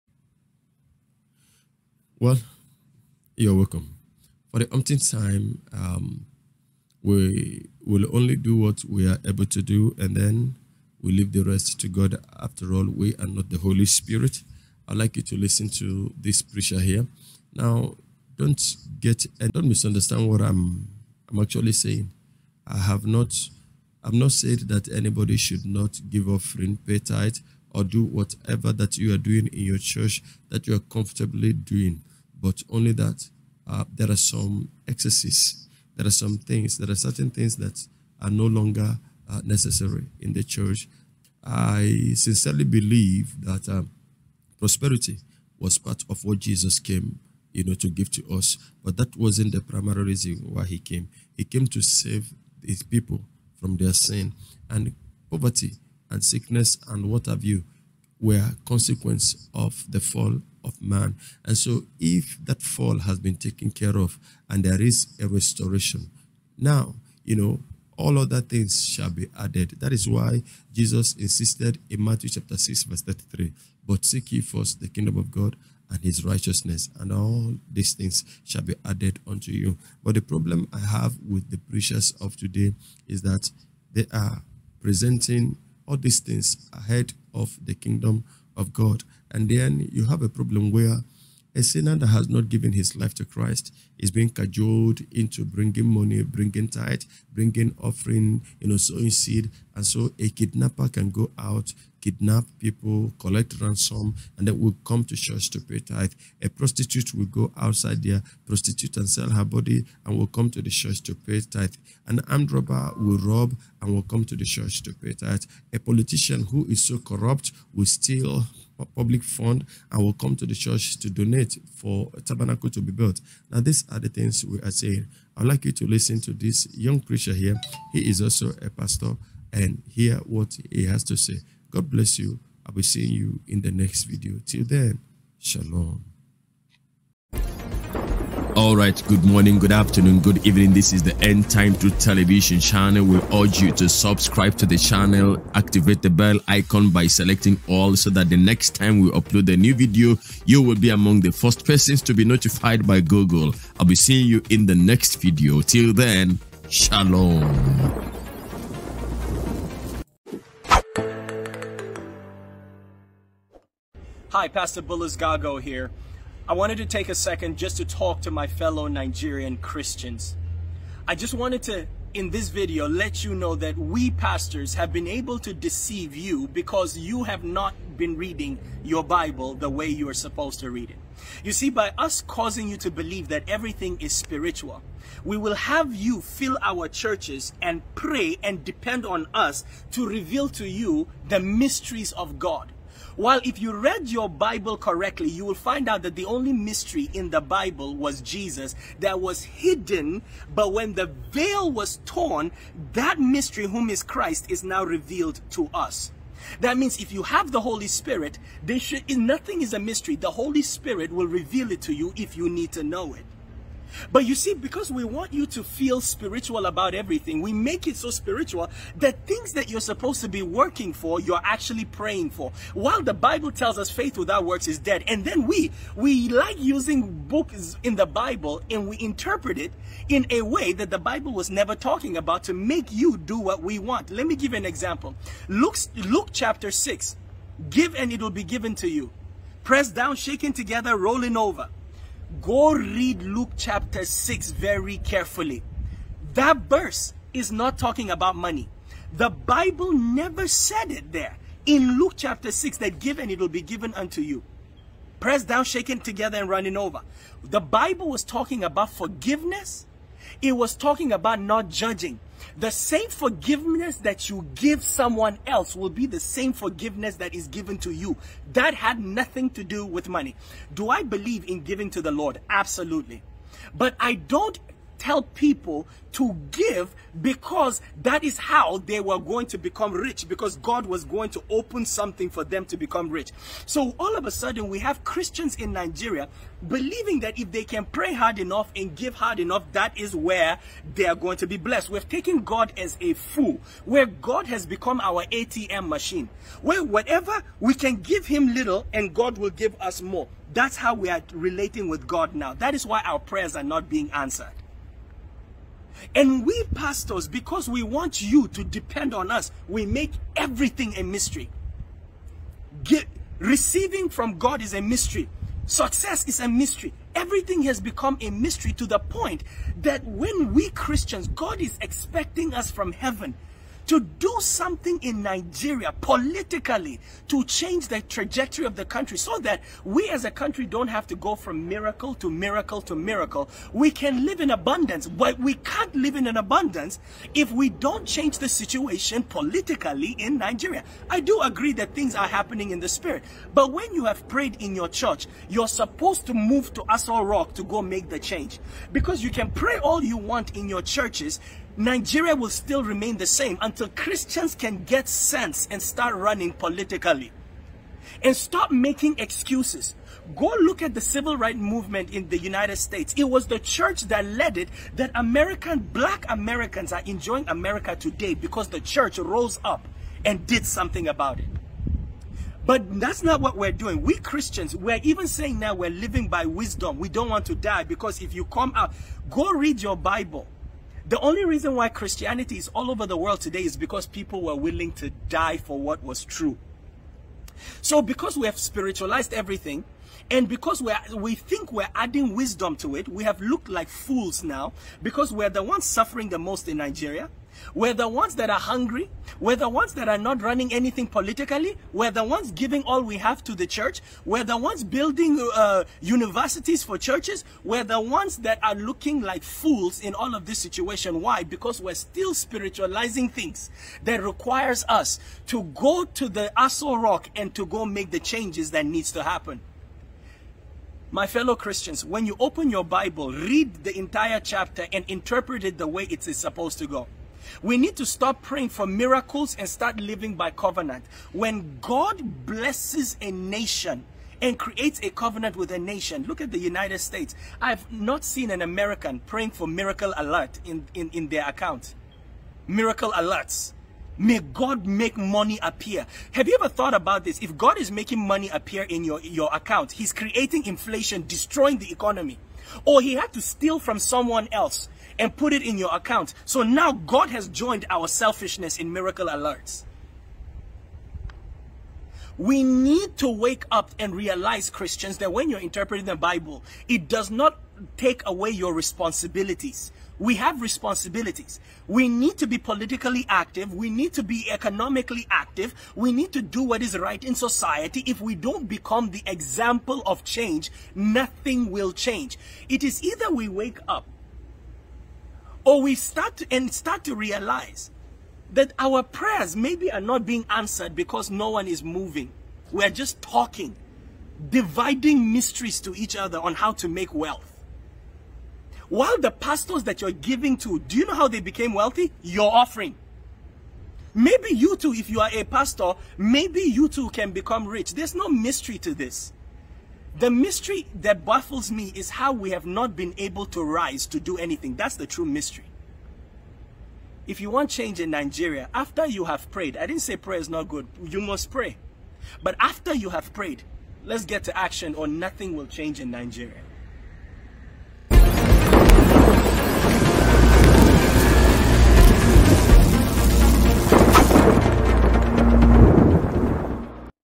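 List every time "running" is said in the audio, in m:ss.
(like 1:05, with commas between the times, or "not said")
4:16, 5:56, 6:40.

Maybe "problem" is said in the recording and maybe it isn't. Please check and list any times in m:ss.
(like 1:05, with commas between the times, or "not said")
1:20, 1:30.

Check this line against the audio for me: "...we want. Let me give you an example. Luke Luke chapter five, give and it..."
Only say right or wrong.
wrong.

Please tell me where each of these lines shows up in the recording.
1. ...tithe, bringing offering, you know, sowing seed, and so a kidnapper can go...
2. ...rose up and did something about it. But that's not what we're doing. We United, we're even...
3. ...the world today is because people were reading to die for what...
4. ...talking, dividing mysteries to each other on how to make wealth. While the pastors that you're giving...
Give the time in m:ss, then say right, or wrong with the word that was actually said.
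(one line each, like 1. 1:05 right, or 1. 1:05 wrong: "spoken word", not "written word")
1. 1:36 right
2. 6:09 wrong: "Christians", not "United"
3. 6:23 wrong: "willing", not "reading"
4. 8:13 right.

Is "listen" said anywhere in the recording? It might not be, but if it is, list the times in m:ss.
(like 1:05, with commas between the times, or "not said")
0:15, 2:05.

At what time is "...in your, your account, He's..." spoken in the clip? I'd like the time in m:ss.
7:28.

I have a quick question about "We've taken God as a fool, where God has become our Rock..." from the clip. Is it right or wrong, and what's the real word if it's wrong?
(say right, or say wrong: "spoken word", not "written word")
wrong: "ATM", not "Rock".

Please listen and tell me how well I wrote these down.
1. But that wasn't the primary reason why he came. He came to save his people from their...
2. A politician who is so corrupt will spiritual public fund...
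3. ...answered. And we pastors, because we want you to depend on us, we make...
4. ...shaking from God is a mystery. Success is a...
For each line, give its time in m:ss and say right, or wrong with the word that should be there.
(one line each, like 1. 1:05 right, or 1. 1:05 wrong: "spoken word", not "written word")
1. 0:48 right
2. 1:55 wrong: "steal", not "spiritual"
3. 5:04 right
4. 5:13 wrong: "receiving", not "shaking".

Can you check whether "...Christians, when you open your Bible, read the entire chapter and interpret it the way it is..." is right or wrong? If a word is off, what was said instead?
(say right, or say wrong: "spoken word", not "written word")
right.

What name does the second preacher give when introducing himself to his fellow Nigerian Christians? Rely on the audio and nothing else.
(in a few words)
Pastor Bullis Gago.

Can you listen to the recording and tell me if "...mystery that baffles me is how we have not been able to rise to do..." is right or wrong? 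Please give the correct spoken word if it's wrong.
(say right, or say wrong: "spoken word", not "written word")
right.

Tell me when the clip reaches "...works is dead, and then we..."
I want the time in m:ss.
3:44.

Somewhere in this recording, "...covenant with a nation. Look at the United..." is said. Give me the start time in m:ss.
7:15.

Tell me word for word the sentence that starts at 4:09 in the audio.
The Bible never said it there.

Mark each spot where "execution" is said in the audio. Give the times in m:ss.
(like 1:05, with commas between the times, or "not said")
not said.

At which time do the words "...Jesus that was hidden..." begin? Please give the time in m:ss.
3:18.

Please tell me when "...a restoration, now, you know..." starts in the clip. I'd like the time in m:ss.
1:05.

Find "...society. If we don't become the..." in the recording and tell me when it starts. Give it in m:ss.
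7:57.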